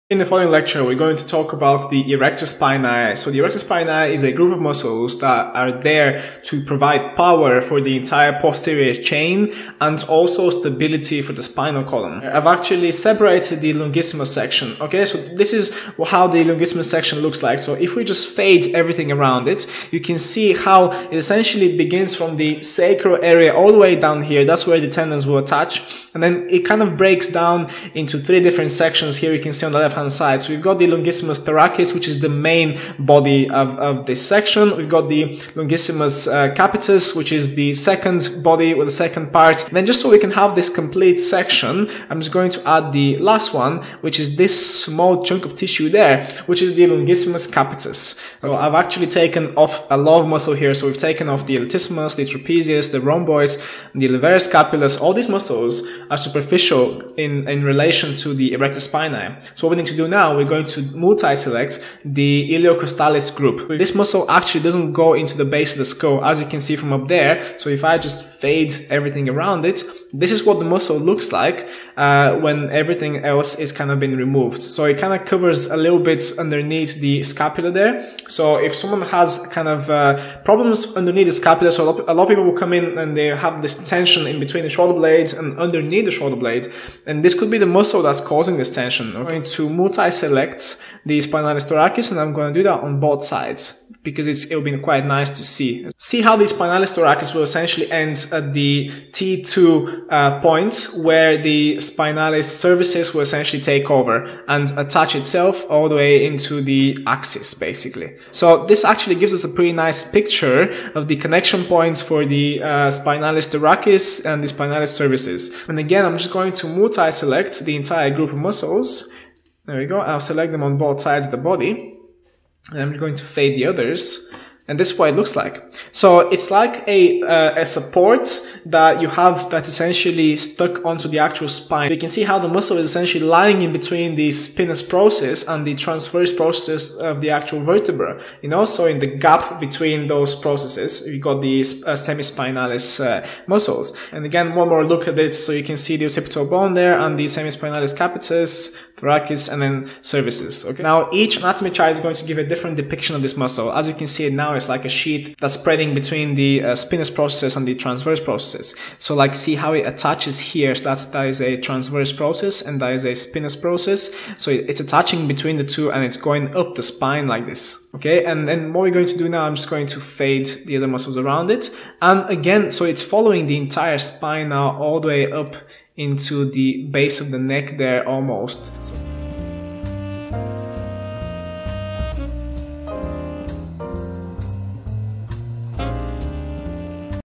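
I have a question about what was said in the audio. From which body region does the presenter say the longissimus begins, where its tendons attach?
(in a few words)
sacral area.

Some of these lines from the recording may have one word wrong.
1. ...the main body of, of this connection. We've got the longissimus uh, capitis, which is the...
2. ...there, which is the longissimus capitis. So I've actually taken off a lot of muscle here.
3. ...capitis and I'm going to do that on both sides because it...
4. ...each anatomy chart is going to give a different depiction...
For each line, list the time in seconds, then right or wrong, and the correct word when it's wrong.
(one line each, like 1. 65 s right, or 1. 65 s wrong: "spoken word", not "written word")
1. 32 s wrong: "section", not "connection"
2. 45 s right
3. 91 s wrong: "thoracis", not "capitis"
4. 151 s right.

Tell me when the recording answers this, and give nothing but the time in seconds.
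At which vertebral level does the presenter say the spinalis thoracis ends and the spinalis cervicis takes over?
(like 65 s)
99 s.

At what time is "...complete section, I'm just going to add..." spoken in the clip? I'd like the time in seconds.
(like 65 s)
40 s.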